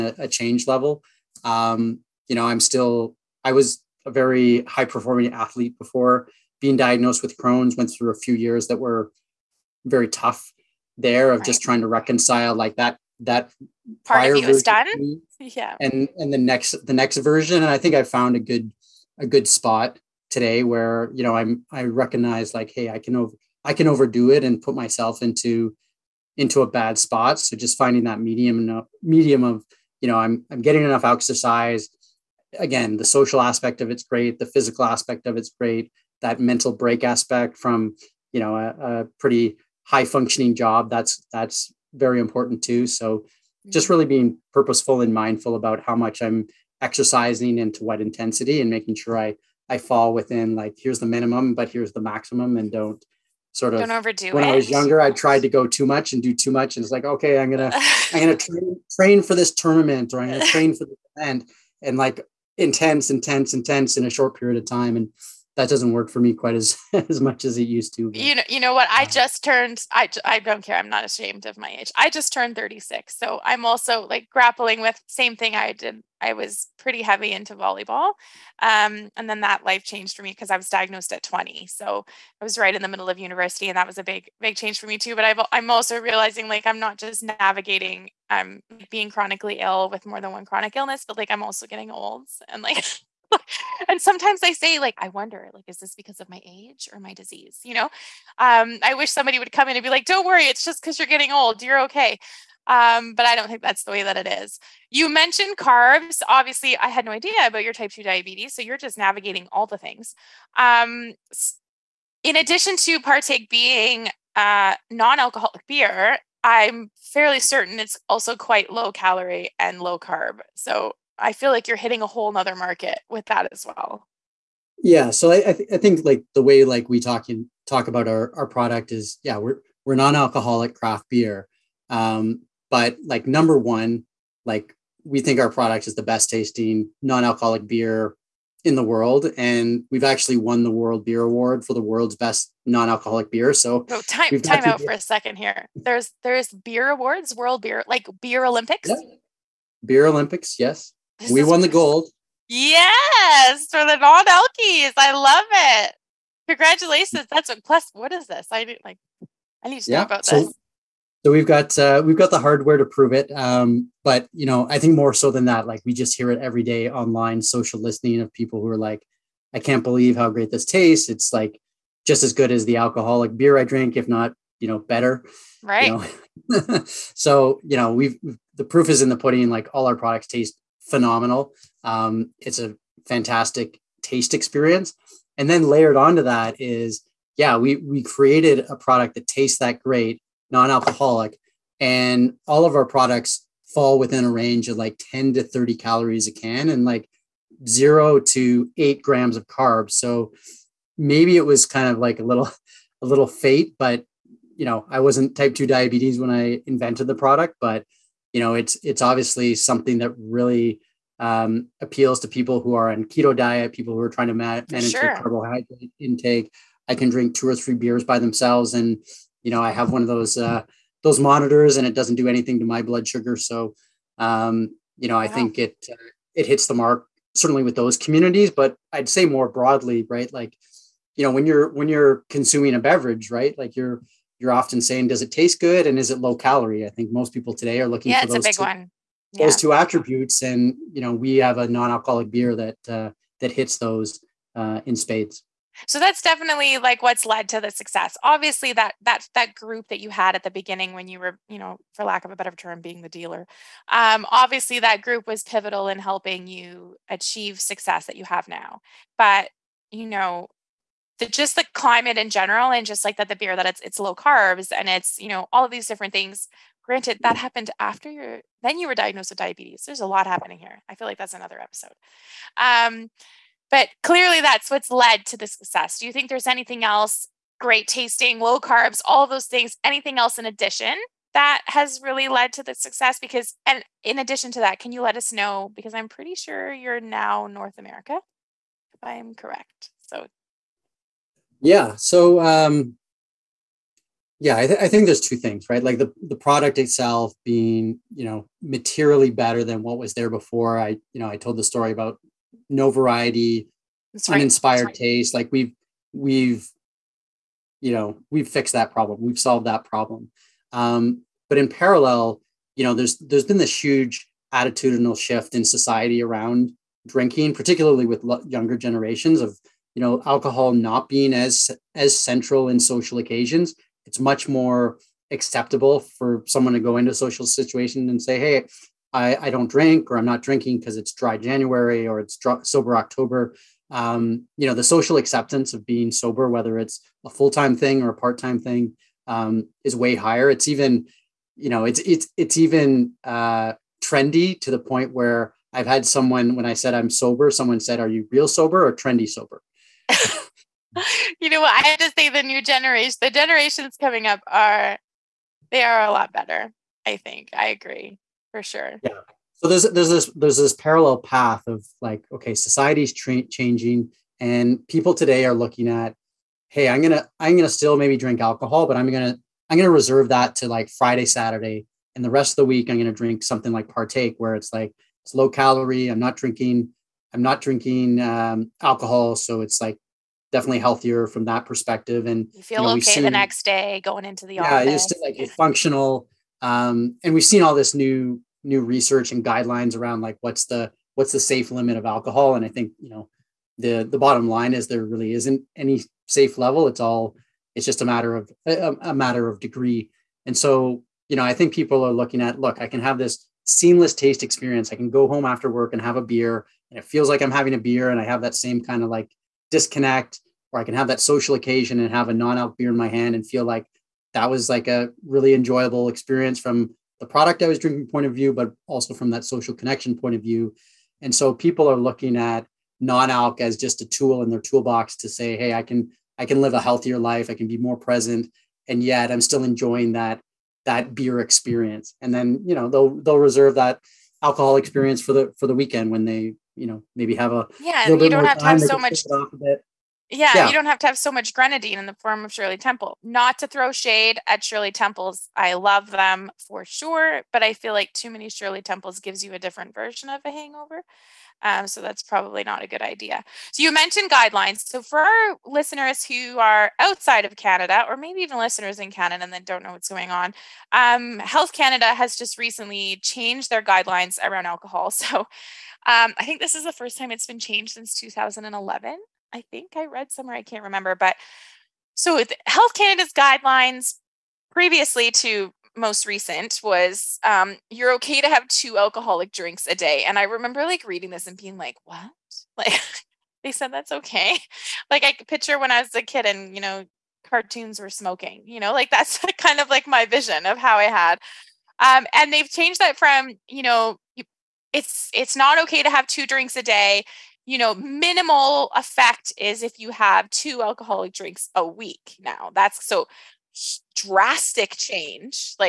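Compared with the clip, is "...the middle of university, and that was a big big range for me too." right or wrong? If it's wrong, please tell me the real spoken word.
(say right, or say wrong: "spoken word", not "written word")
wrong: "change", not "range".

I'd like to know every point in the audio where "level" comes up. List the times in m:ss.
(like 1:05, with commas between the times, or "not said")
0:00, 6:36.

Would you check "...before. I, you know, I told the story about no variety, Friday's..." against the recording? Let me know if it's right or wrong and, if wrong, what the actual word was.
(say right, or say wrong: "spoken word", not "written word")
wrong: "That", not "Friday".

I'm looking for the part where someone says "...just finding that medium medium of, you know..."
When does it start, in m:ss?
0:27.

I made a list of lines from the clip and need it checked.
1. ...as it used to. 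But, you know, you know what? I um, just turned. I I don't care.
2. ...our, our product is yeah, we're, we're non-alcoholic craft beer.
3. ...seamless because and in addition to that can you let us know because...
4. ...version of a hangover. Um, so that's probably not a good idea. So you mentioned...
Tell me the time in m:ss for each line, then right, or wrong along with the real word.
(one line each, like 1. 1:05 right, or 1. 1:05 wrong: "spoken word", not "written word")
1. 1:07 right
2. 2:08 right
3. 4:42 wrong: "success", not "seamless"
4. 7:29 right.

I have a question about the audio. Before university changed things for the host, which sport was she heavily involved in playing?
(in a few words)
volleyball.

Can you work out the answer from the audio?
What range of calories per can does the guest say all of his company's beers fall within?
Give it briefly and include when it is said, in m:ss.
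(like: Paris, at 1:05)
10 to 30, at 3:15.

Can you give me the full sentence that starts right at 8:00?
And I remember like reading this and being like, what?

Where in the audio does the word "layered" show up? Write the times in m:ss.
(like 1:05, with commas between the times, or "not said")
3:05.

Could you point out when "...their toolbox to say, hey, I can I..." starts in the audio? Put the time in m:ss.
7:04.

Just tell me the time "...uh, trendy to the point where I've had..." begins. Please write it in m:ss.
5:43.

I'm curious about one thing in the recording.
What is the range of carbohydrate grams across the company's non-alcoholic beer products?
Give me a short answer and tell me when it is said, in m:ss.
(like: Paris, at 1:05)
0 to 8 grams, at 3:17.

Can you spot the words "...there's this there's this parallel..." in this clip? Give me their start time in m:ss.
5:59.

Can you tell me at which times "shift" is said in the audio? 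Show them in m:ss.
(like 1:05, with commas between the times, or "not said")
5:15.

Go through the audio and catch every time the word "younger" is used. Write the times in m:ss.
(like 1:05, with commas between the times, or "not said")
0:54, 5:18.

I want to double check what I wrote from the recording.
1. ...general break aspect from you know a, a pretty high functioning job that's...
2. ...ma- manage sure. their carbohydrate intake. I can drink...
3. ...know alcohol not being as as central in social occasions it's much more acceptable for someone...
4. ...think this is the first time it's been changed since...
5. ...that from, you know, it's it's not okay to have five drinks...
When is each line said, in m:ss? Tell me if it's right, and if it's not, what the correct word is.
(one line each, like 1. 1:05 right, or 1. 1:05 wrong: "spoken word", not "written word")
1. 0:36 wrong: "mental", not "general"
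2. 3:34 right
3. 5:19 right
4. 7:46 right
5. 8:12 wrong: "two", not "five".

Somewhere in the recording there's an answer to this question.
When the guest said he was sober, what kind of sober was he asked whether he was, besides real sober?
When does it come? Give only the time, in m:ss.
5:48.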